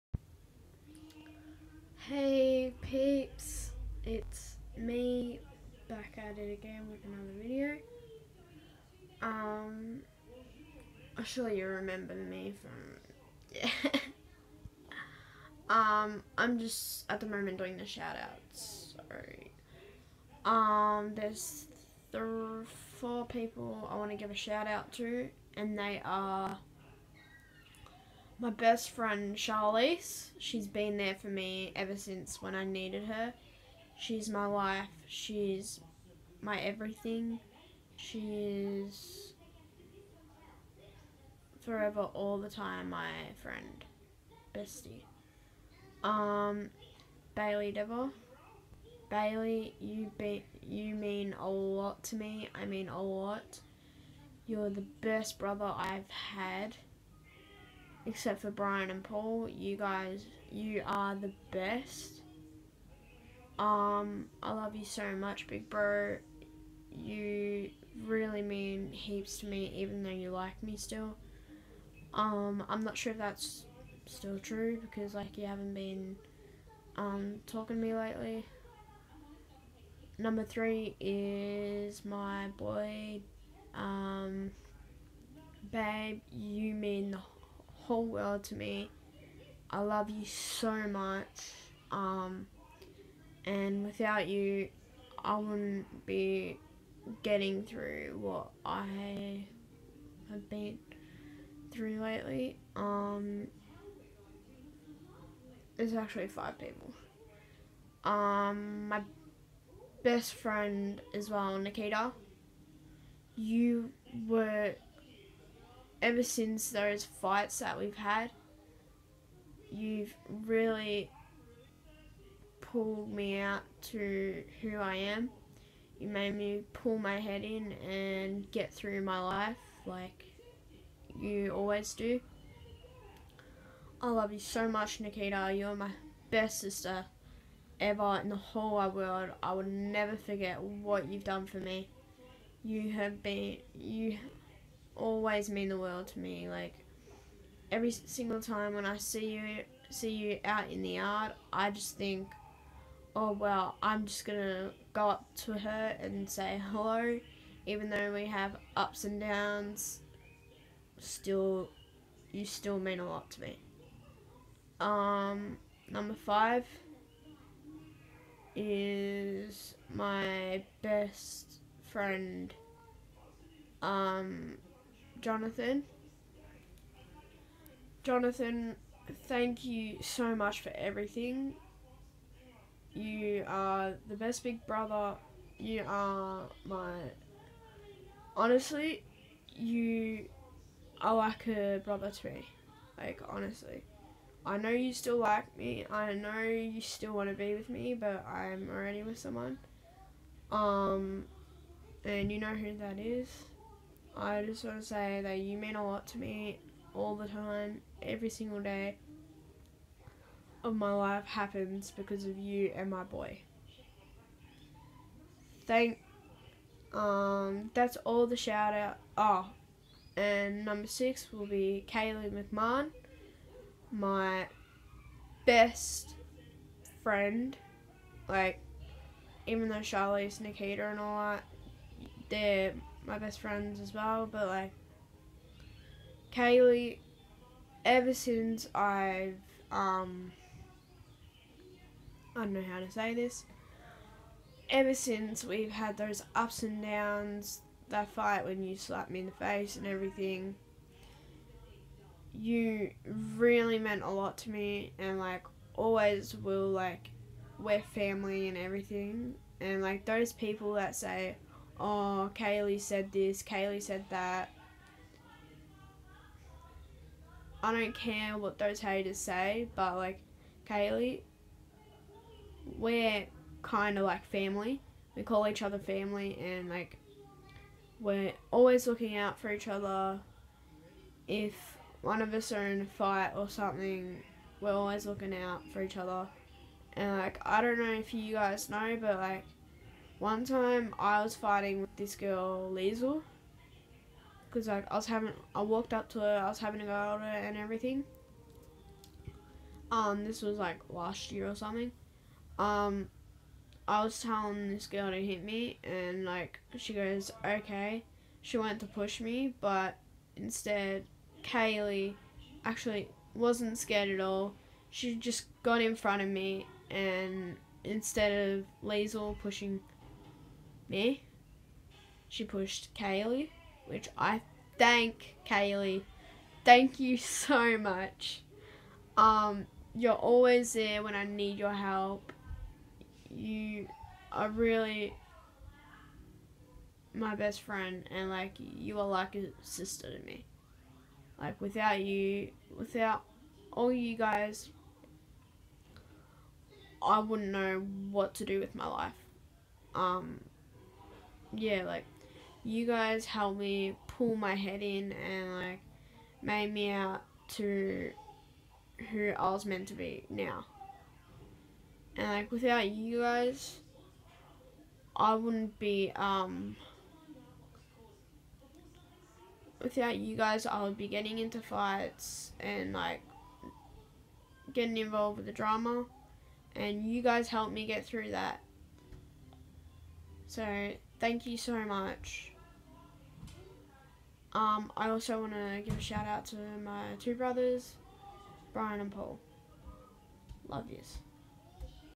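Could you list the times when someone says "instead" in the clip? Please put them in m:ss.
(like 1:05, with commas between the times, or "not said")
5:10, 5:17.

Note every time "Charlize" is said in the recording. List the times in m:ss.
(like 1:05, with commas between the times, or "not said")
0:29, 3:49.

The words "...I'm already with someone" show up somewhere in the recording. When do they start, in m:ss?
3:18.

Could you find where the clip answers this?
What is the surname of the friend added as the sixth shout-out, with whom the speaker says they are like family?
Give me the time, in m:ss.
3:42.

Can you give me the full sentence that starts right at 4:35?
We call each other family, and like, we're always looking out for each other.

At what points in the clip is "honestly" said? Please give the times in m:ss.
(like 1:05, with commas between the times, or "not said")
3:08, 3:13.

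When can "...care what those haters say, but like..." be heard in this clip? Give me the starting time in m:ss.
4:27.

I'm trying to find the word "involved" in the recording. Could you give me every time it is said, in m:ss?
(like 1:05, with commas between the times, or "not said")
6:14.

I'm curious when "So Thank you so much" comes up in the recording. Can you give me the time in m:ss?
6:20.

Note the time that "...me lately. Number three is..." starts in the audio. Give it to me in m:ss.
1:17.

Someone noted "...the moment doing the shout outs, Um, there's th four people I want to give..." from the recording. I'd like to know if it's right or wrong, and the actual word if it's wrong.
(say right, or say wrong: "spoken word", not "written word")
right.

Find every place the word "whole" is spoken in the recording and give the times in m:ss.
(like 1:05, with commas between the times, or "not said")
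1:27, 2:18.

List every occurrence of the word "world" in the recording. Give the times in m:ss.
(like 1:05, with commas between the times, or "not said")
1:28, 2:18, 2:25.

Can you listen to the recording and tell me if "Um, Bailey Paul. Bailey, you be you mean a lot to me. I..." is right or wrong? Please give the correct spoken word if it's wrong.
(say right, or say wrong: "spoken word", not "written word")
wrong: "Devil", not "Paul".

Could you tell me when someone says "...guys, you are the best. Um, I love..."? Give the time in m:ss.
0:59.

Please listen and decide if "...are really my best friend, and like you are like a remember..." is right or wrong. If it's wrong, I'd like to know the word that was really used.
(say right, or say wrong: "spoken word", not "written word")
wrong: "sister", not "remember".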